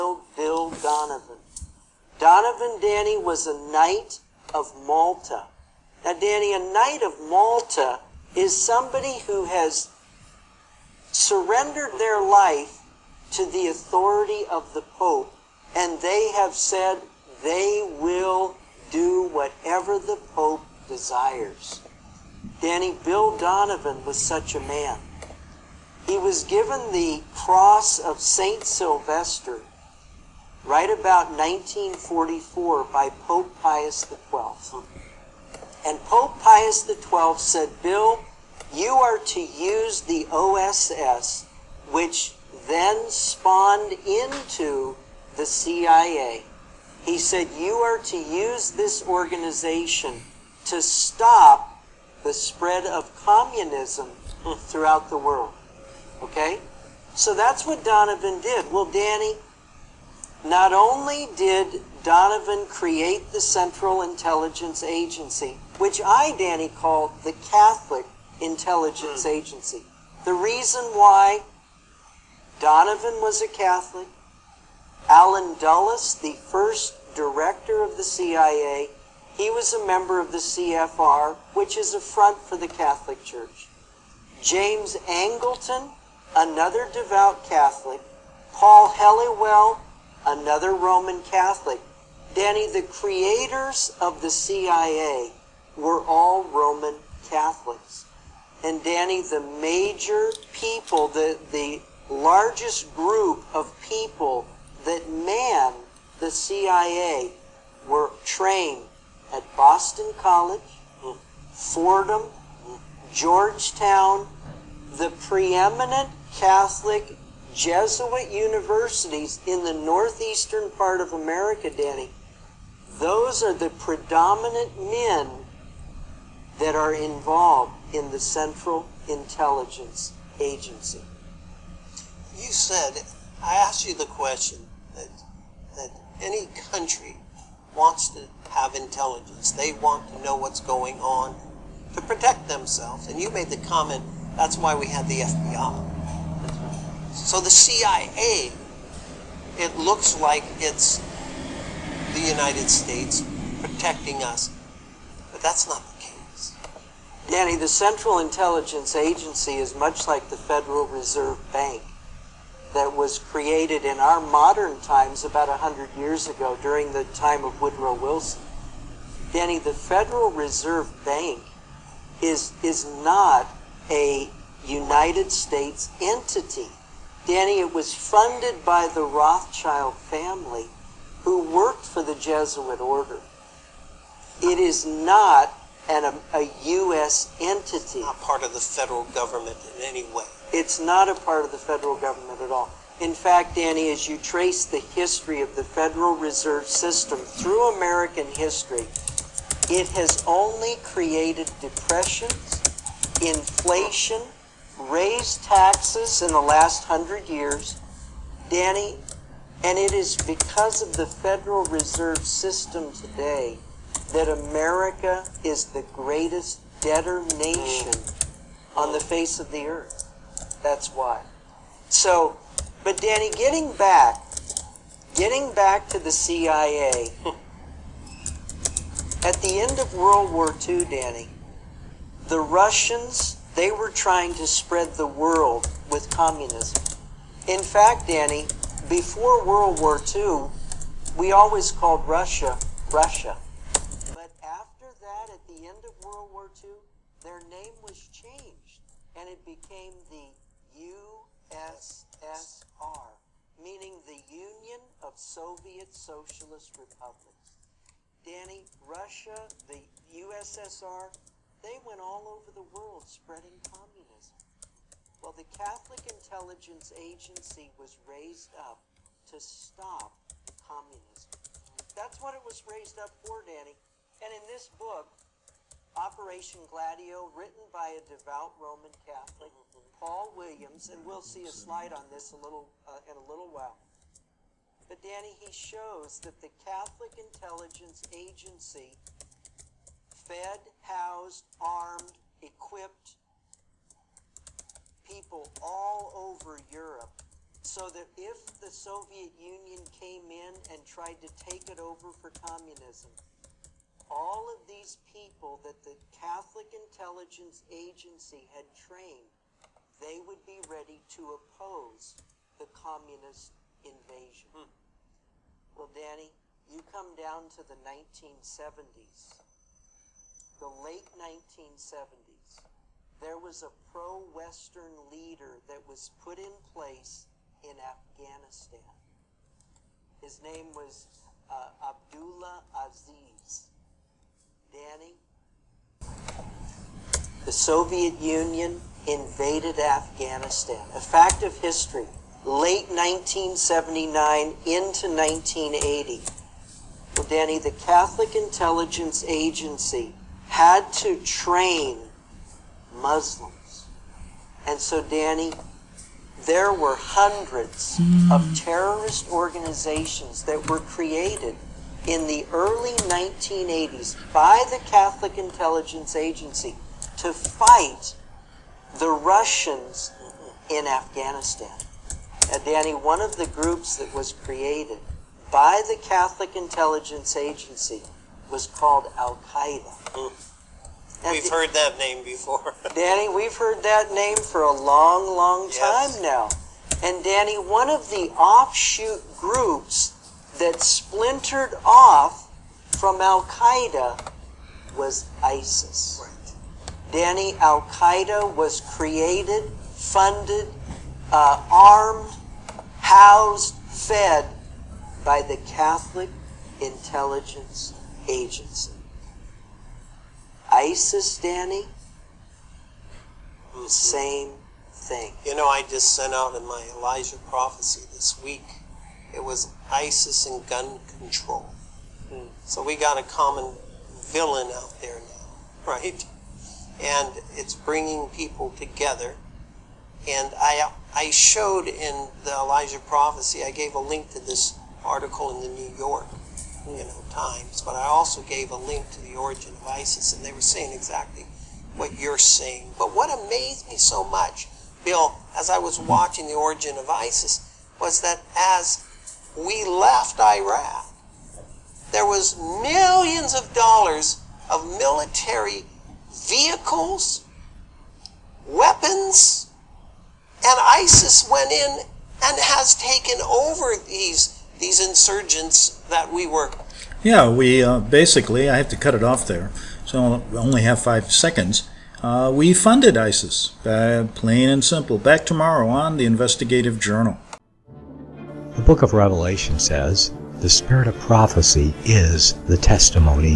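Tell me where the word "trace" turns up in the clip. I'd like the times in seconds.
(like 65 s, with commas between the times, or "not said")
194 s.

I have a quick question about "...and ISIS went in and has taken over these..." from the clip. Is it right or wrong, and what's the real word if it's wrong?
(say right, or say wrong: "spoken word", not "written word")
right.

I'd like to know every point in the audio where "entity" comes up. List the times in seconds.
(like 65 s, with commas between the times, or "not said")
176 s, 187 s.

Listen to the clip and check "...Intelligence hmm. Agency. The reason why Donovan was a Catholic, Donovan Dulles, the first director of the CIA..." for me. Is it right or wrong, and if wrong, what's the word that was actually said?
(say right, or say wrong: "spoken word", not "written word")
wrong: "Allen", not "Donovan".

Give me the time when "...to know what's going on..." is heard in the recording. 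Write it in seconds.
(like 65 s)
140 s.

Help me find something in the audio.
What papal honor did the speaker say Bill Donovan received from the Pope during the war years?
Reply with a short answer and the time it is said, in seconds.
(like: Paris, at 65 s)
Cross of St. Sylvester, at 27 s.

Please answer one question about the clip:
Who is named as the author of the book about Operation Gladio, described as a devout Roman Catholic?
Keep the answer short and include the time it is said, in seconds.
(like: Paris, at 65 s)
Paul Williams, at 279 s.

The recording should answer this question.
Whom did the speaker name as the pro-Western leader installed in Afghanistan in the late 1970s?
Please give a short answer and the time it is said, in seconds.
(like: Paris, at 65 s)
Abdullah Aziz, at 331 s.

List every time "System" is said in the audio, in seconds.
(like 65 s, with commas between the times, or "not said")
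196 s, 212 s.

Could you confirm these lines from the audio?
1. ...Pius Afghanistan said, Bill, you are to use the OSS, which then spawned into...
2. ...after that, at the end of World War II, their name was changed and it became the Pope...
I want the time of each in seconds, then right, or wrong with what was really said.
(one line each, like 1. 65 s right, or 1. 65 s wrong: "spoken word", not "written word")
1. 36 s wrong: "XII", not "Afghanistan"
2. 244 s wrong: "USSR", not "Pope".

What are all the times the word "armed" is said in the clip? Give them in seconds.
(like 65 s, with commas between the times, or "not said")
291 s, 401 s.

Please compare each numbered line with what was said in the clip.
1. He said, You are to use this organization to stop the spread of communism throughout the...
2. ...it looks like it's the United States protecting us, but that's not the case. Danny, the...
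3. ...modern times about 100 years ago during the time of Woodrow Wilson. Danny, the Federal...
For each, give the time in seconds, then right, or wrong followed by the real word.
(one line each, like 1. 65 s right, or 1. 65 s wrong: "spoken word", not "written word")
1. 47 s right
2. 149 s right
3. 164 s right.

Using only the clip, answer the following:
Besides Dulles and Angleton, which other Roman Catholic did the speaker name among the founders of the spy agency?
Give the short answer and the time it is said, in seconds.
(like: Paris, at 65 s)
Paul Helliwell, at 88 s.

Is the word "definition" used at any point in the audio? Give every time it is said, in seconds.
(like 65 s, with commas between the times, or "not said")
not said.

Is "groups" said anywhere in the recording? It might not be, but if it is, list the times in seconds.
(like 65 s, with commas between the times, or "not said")
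102 s, 373 s, 389 s.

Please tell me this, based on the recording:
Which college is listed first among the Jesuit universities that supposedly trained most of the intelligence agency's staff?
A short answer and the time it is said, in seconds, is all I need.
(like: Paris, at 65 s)
Boston College, at 109 s.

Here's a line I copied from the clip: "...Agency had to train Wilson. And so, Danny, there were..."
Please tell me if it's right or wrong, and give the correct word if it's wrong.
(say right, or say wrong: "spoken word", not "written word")
wrong: "Muslims", not "Wilson".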